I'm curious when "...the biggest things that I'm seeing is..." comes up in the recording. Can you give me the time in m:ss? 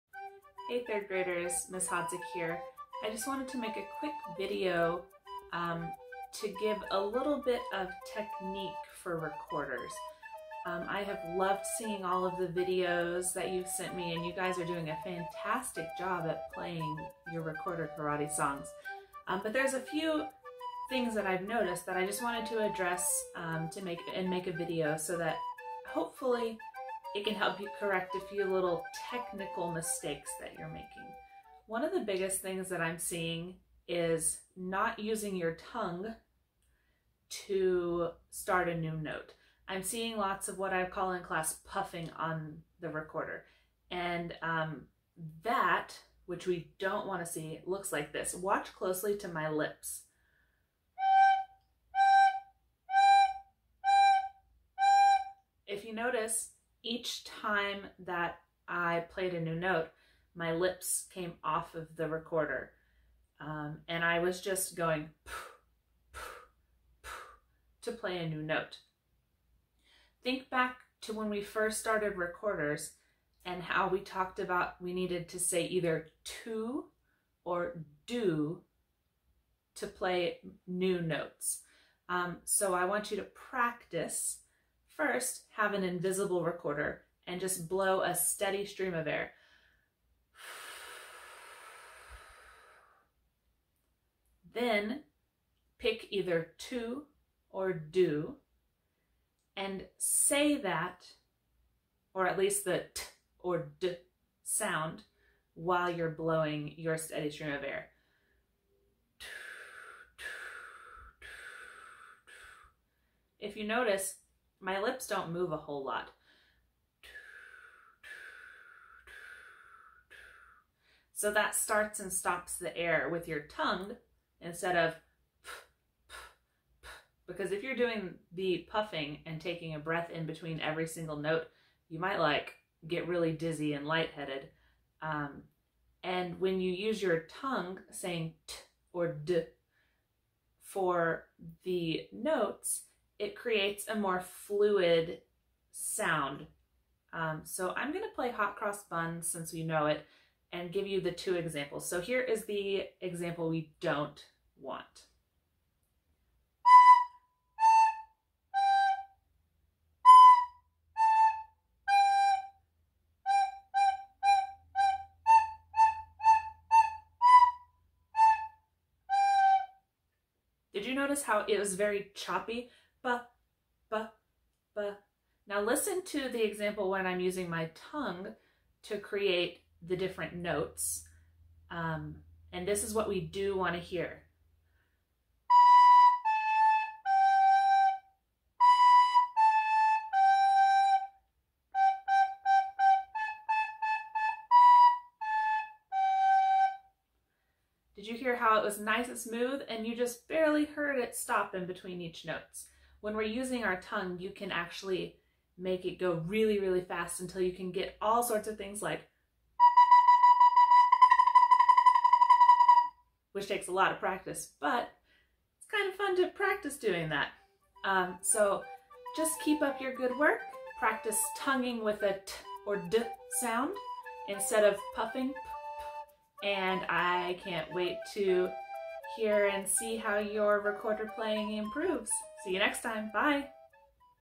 0:31.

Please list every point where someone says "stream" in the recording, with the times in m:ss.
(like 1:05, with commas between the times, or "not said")
1:28, 1:47.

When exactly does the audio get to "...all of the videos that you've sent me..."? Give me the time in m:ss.
0:12.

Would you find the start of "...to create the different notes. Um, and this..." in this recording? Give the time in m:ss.
2:58.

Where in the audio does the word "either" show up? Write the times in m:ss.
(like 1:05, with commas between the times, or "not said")
1:15, 1:36.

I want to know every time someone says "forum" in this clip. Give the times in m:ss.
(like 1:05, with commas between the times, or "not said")
not said.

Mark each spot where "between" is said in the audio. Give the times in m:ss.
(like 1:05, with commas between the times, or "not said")
2:10, 3:21.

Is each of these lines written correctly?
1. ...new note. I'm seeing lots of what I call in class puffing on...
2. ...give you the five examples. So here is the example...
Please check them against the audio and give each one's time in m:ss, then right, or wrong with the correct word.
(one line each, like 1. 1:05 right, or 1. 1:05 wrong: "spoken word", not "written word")
1. 0:38 right
2. 2:30 wrong: "two", not "five".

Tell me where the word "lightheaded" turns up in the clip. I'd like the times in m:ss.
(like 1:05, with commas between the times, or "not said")
2:13.